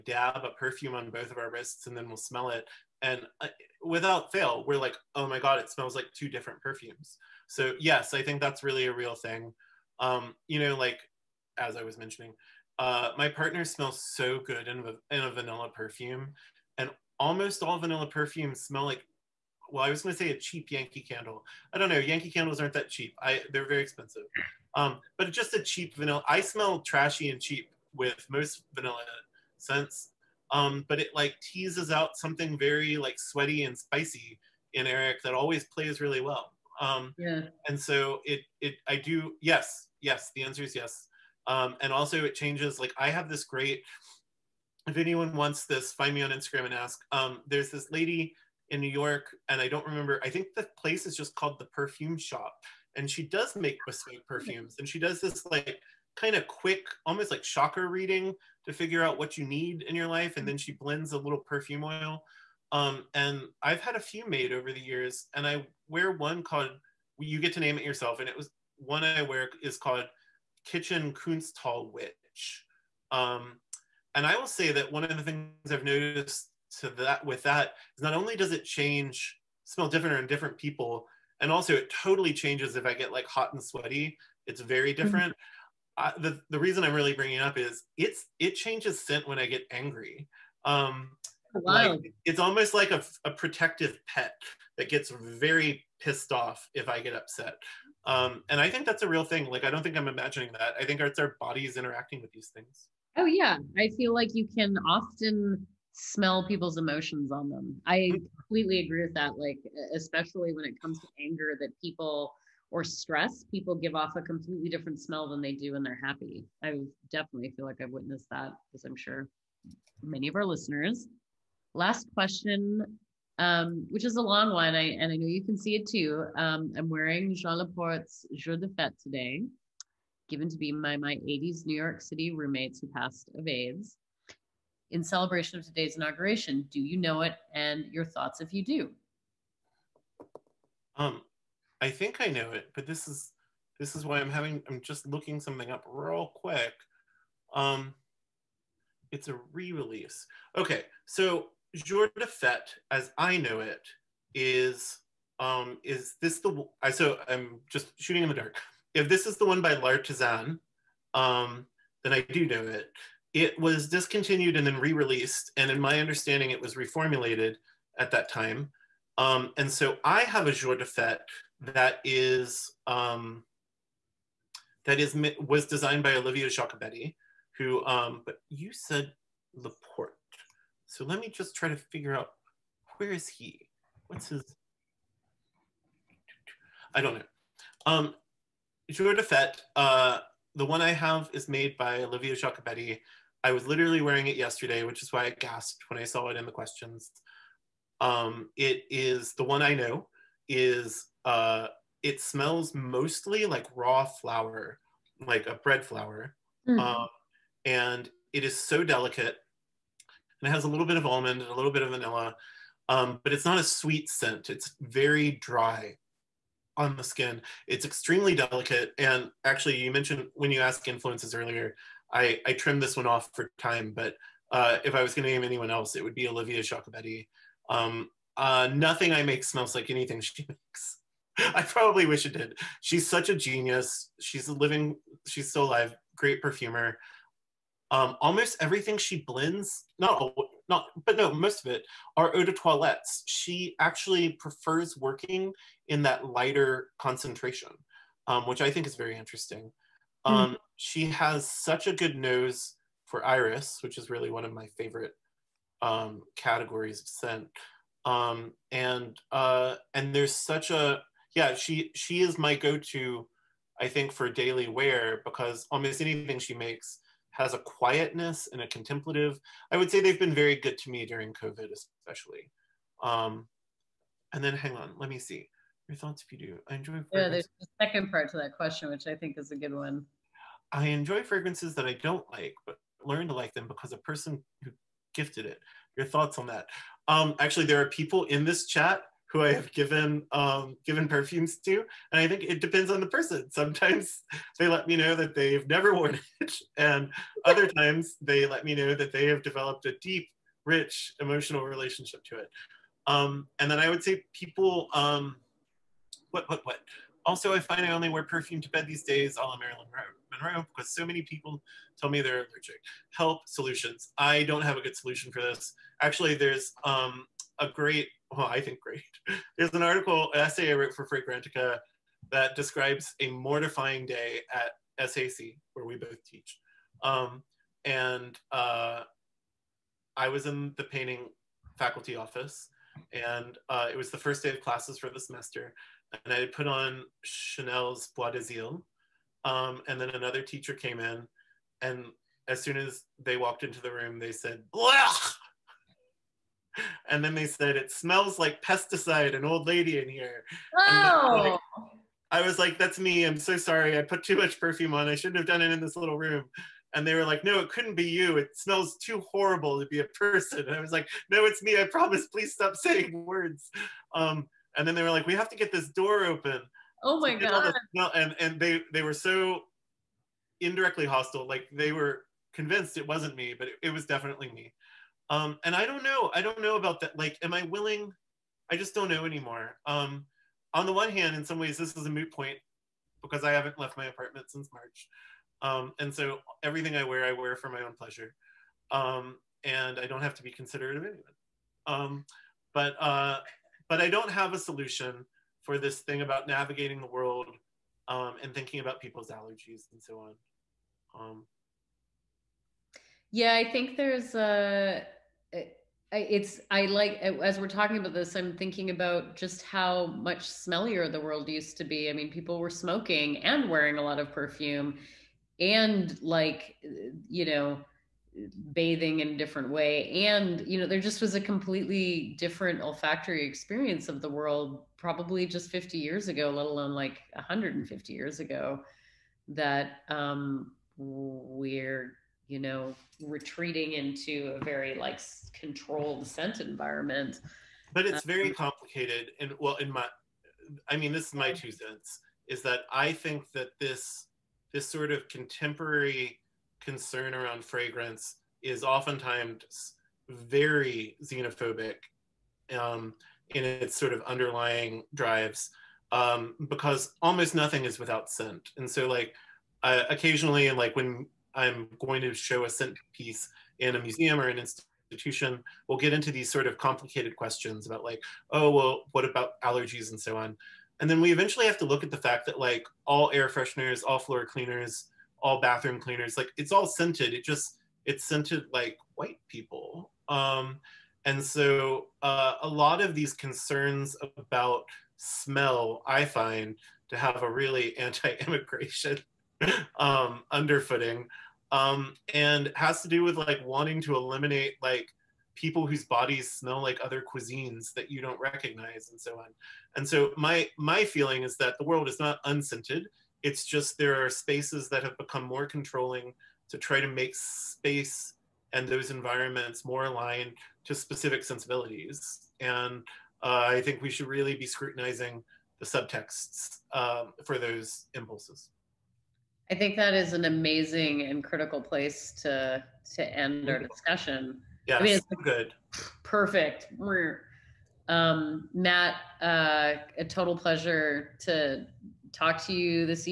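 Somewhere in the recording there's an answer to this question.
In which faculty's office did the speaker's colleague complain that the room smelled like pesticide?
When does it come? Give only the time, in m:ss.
5:30.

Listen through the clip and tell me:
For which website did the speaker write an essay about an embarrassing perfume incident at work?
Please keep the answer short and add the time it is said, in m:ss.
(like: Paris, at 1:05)
Fragrantica, at 5:21.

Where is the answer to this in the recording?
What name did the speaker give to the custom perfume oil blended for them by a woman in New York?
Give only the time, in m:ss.
1:10.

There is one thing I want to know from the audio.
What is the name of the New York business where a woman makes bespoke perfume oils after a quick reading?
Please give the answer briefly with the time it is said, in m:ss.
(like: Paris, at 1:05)
the Perfume Shop, at 0:51.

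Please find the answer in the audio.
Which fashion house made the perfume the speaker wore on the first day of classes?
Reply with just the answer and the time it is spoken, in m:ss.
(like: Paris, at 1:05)
Chanel, at 5:37.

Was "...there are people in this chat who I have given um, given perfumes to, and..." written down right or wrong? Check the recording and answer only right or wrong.
right.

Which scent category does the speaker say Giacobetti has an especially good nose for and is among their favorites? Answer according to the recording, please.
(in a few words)
iris.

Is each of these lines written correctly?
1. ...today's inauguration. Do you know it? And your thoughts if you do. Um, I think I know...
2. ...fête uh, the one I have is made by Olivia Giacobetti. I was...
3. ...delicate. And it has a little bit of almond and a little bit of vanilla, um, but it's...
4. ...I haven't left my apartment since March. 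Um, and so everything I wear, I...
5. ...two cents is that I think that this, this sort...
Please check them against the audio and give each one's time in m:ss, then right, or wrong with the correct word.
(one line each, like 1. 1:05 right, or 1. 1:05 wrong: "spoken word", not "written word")
1. 2:15 right
2. 3:09 right
3. 3:28 right
4. 6:23 right
5. 7:21 right.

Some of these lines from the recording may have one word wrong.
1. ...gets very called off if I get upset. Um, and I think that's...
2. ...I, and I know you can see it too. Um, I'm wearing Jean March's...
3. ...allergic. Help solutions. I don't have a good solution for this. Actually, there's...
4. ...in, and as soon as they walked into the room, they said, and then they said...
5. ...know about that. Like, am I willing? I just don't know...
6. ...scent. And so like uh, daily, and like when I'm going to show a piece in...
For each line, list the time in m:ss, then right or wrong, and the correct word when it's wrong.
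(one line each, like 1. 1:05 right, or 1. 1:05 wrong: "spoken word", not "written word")
1. 1:34 wrong: "pissed", not "called"
2. 2:04 wrong: "Laporte", not "March"
3. 5:12 right
4. 5:40 right
5. 6:16 right
6. 7:38 wrong: "occasionally", not "daily".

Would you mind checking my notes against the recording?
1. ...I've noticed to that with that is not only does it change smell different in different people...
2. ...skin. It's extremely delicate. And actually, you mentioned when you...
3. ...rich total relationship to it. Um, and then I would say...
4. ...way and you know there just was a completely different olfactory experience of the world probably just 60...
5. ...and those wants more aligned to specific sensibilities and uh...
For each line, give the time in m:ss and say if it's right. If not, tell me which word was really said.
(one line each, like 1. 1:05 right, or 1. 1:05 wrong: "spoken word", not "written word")
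1. 1:15 right
2. 3:37 right
3. 5:00 wrong: "emotional", not "total"
4. 6:59 wrong: "50", not "60"
5. 8:28 wrong: "environments", not "wants".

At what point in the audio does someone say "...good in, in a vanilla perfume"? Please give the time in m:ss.
0:14.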